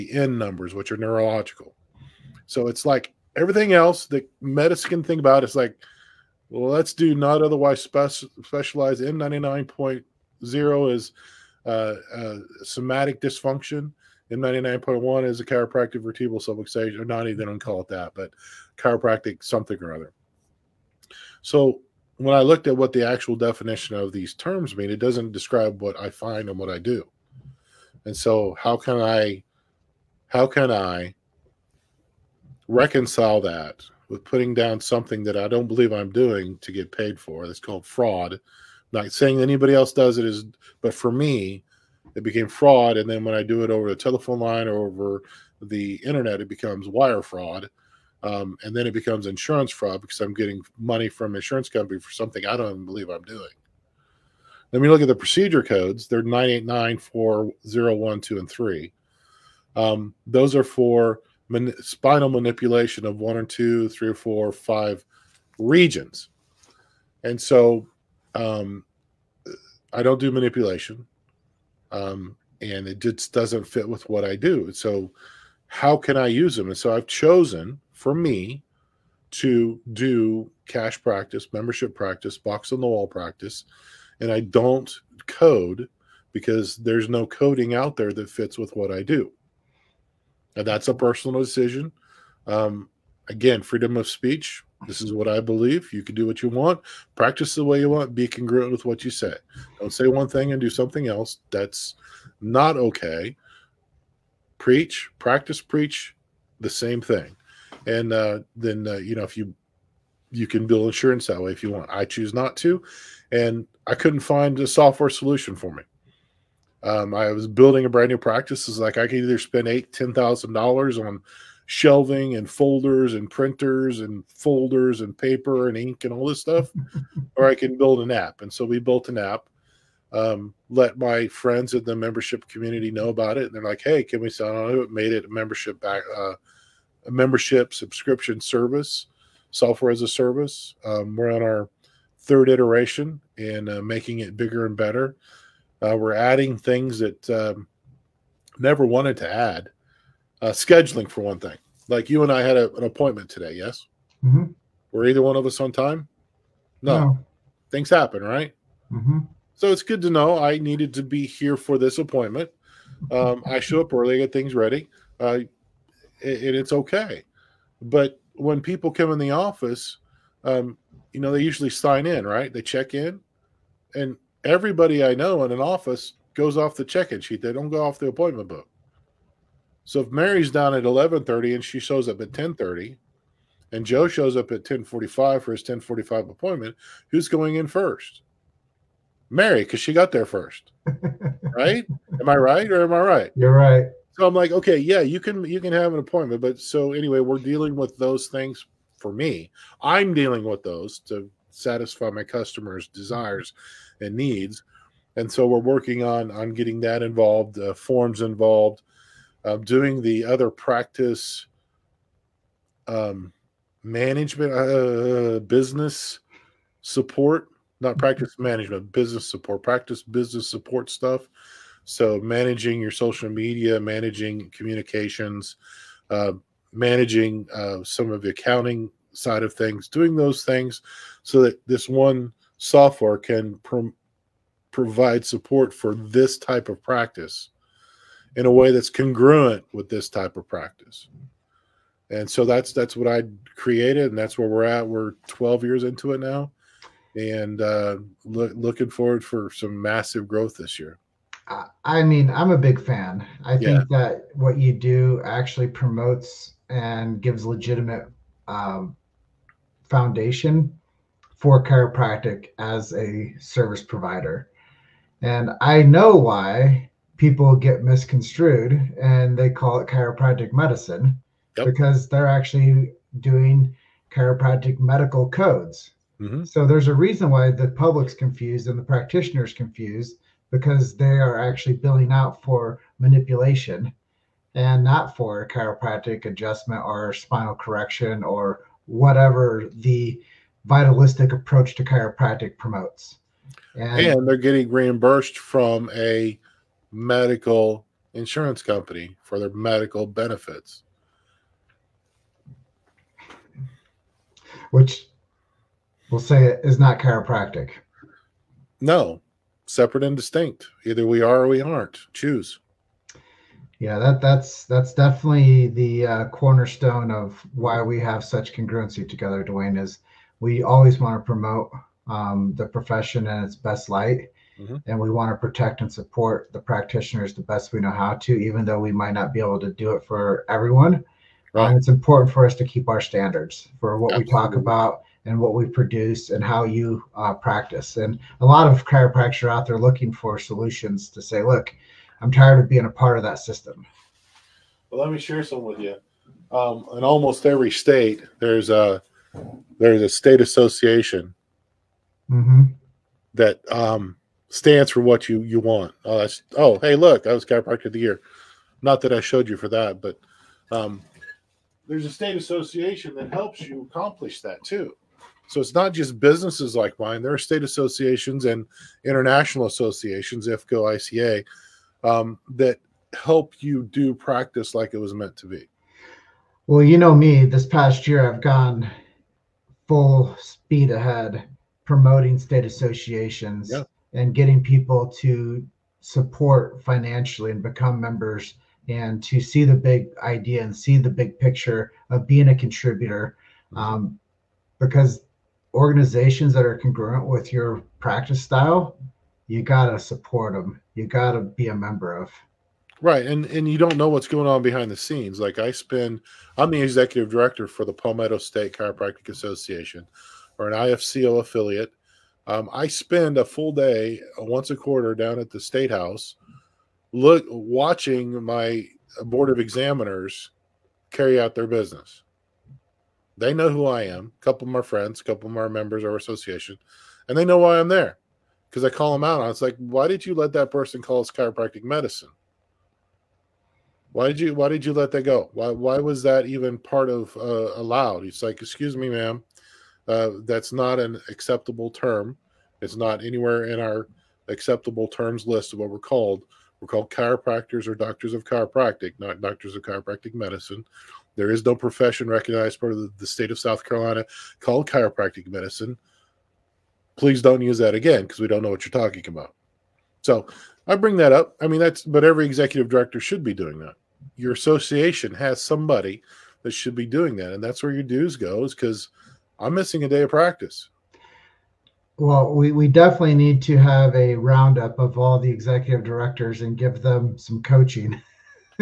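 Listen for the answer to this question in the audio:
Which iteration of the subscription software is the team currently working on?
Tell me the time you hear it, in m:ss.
2:22.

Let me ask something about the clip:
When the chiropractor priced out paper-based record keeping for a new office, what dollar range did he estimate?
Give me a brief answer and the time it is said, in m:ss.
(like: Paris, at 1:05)
$8,000-$10,000, at 1:59.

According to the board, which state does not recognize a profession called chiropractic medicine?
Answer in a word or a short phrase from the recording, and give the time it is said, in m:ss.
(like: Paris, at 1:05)
South Carolina, at 7:33.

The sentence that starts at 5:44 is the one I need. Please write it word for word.
Well, let me share some with you.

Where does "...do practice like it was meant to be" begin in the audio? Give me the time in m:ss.
6:13.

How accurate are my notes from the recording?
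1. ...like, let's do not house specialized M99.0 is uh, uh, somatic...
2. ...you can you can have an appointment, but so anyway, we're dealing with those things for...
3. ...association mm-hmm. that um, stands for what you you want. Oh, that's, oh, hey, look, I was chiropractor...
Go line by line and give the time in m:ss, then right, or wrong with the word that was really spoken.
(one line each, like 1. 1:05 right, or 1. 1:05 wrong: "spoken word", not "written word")
1. 0:05 wrong: "otherwise", not "house"
2. 3:15 right
3. 5:50 right.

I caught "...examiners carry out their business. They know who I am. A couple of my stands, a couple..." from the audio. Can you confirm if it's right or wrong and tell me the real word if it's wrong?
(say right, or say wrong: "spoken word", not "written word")
wrong: "friends", not "stands".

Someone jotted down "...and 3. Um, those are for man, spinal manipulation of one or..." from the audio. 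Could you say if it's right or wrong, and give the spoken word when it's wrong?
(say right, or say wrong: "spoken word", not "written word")
right.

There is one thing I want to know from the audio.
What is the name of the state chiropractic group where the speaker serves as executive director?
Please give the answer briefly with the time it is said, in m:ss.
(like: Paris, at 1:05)
Palmetto State Chiropractic Association, at 6:47.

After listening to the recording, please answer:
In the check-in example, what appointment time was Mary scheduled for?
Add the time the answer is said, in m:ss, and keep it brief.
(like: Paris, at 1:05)
11:30, at 3:00.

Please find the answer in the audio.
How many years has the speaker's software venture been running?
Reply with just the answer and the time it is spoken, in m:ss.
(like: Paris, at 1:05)
12, at 4:05.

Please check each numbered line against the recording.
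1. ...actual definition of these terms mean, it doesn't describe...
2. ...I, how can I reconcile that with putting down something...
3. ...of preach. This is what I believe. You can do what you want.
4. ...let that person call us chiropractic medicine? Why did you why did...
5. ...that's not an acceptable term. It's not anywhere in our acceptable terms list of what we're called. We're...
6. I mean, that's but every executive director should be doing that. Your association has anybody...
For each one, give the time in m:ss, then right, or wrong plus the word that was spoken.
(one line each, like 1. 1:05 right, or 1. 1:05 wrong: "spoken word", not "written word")
1. 0:23 right
2. 0:29 right
3. 1:33 wrong: "speech", not "preach"
4. 7:10 right
5. 7:20 right
6. 7:41 wrong: "somebody", not "anybody".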